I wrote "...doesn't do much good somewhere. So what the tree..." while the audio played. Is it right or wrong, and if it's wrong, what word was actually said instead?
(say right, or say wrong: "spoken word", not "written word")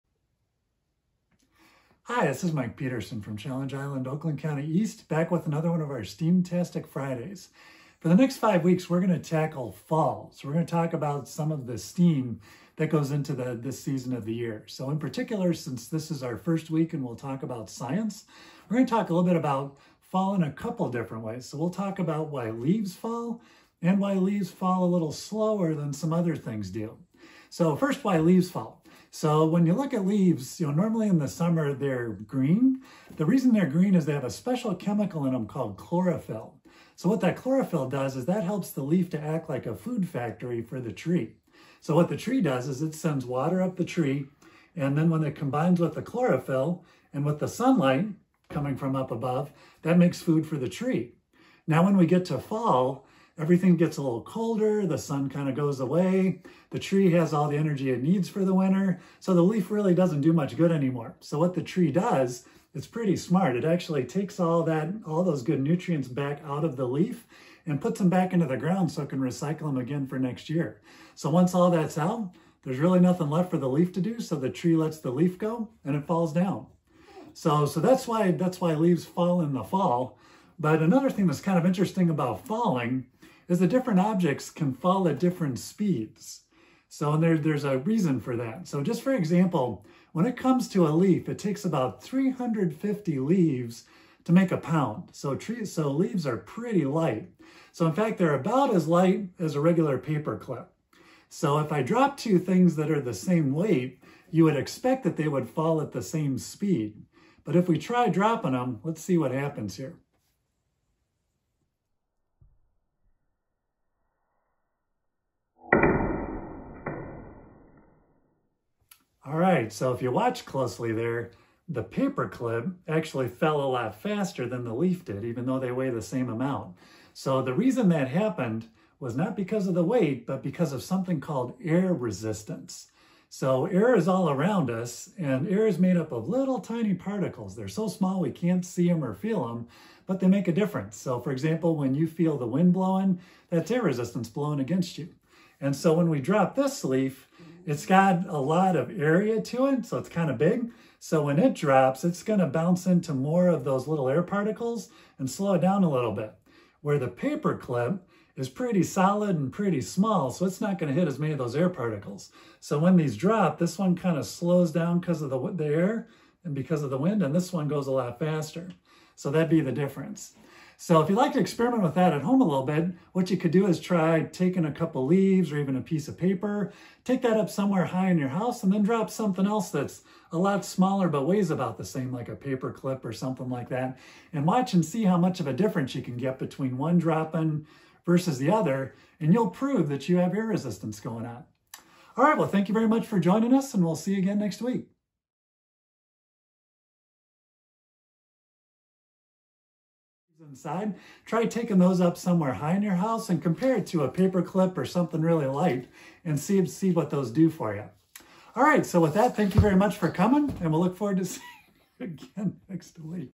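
wrong: "anymore", not "somewhere".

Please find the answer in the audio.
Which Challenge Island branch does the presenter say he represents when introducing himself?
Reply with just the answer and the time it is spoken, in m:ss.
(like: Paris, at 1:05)
Oakland County East, at 0:04.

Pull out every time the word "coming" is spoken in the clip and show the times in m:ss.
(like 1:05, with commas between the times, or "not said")
0:48, 3:30.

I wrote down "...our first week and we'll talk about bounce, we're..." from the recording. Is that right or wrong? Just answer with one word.
wrong.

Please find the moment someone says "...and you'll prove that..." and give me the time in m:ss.
3:09.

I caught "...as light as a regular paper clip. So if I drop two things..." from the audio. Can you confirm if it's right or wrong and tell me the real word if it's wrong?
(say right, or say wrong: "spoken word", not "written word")
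right.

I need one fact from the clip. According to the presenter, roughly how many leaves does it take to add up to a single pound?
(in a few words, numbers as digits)
350.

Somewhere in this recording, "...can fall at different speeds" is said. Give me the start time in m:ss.
1:24.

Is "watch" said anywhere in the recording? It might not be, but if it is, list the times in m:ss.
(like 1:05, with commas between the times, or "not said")
2:00, 3:04.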